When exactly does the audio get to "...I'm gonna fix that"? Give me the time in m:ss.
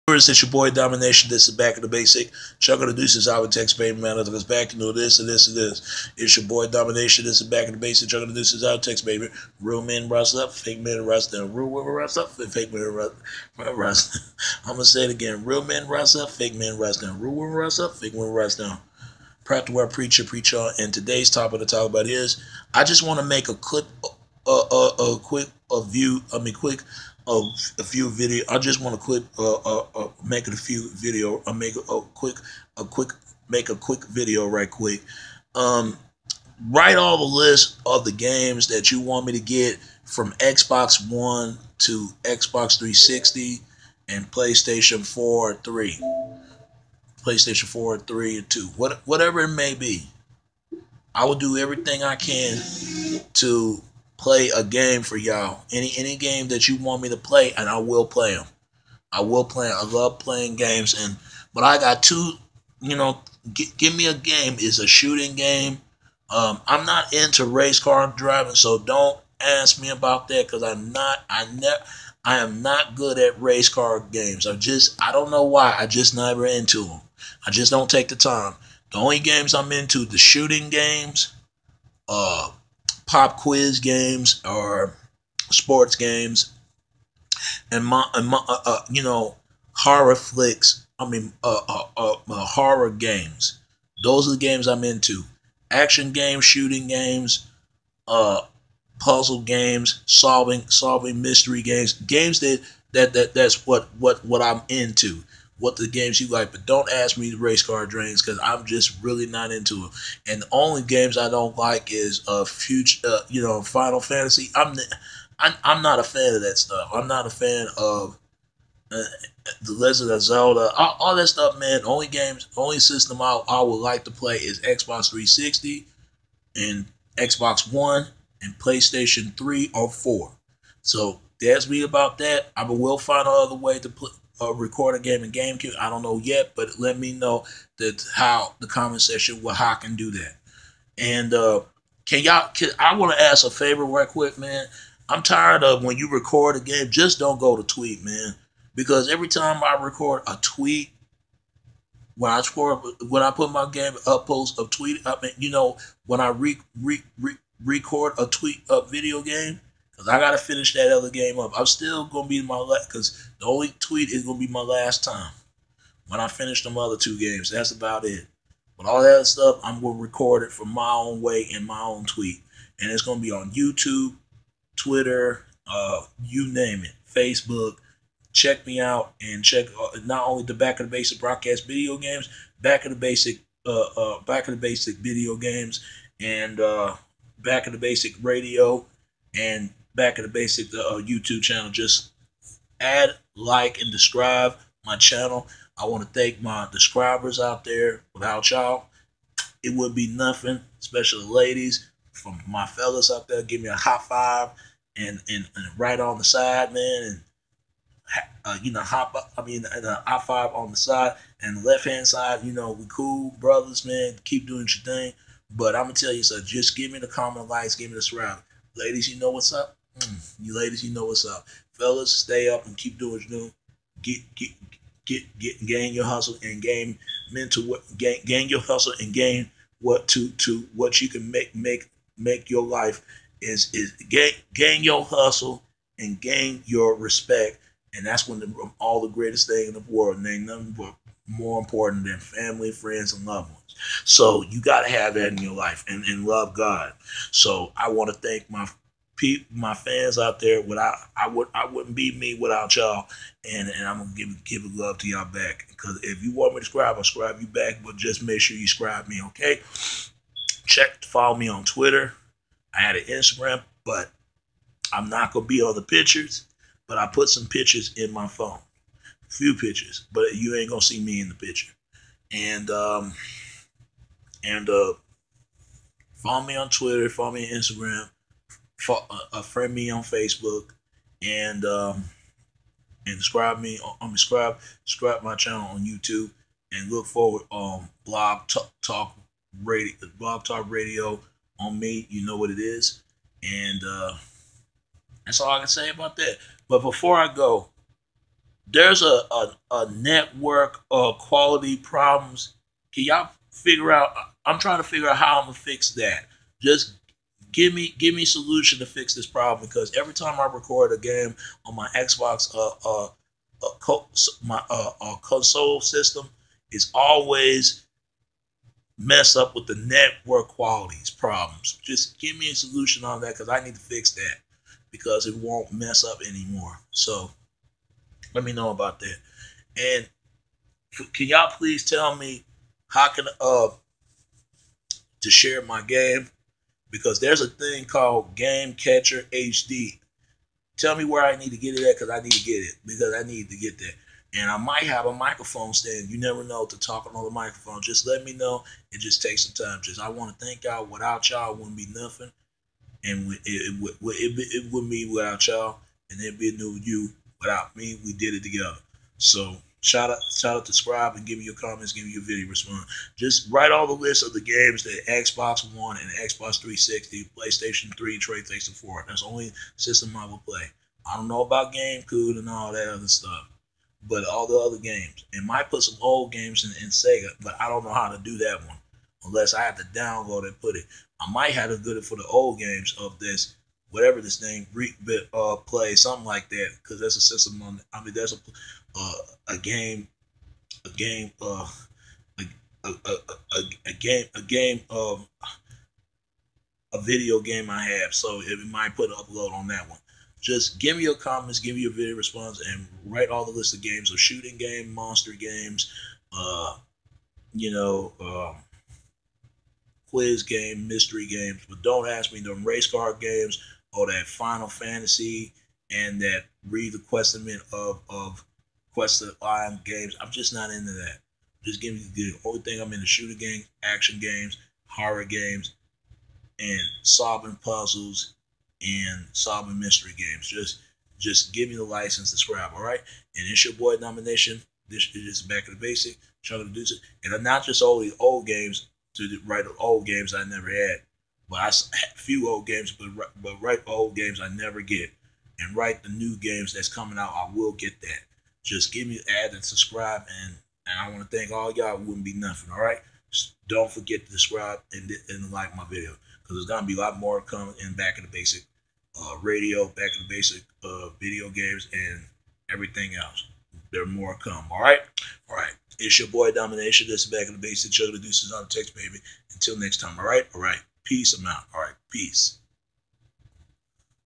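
5:05.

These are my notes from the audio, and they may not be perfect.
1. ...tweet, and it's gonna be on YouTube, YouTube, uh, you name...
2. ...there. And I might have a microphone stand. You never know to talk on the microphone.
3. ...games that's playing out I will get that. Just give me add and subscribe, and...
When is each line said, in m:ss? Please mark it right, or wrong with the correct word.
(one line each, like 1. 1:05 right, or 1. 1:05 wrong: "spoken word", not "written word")
1. 2:52 wrong: "Twitter", not "YouTube"
2. 5:43 right
3. 7:26 wrong: "coming", not "playing".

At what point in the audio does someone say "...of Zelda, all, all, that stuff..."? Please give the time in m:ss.
2:00.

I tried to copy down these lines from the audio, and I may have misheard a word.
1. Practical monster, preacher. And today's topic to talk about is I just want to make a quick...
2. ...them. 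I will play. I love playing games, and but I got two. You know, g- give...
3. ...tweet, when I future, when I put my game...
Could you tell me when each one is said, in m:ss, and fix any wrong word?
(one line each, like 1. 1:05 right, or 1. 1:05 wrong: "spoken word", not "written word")
1. 0:19 wrong: "preacher", not "monster"
2. 0:58 right
3. 2:30 wrong: "score", not "future".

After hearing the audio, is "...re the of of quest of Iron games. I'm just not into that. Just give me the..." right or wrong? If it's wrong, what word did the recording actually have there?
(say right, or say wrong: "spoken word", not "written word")
right.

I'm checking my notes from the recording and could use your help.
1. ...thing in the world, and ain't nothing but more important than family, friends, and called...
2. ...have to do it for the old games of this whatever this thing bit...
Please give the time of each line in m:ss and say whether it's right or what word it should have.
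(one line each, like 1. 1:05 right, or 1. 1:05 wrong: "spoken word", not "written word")
1. 3:59 wrong: "loved", not "called"
2. 6:21 right.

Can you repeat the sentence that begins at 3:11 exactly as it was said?
Just add, like, and describe my channel.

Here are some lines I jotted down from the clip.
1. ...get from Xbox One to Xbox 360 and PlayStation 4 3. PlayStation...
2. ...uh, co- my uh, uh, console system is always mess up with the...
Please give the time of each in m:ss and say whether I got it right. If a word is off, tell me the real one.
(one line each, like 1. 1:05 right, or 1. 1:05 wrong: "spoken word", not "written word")
1. 0:39 right
2. 5:13 right.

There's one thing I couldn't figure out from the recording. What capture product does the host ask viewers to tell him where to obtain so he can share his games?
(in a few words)
Game Capture HD.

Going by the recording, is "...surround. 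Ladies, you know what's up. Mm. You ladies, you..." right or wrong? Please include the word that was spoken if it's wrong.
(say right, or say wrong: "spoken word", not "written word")
right.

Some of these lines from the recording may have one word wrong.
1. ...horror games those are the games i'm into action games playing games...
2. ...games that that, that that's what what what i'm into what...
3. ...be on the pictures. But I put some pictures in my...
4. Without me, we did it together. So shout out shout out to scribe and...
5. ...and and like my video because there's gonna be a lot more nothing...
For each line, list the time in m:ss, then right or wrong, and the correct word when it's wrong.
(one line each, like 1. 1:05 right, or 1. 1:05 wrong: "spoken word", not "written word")
1. 1:32 wrong: "shooting", not "playing"
2. 1:41 right
3. 4:25 right
4. 5:57 right
5. 7:34 wrong: "coming", not "nothing".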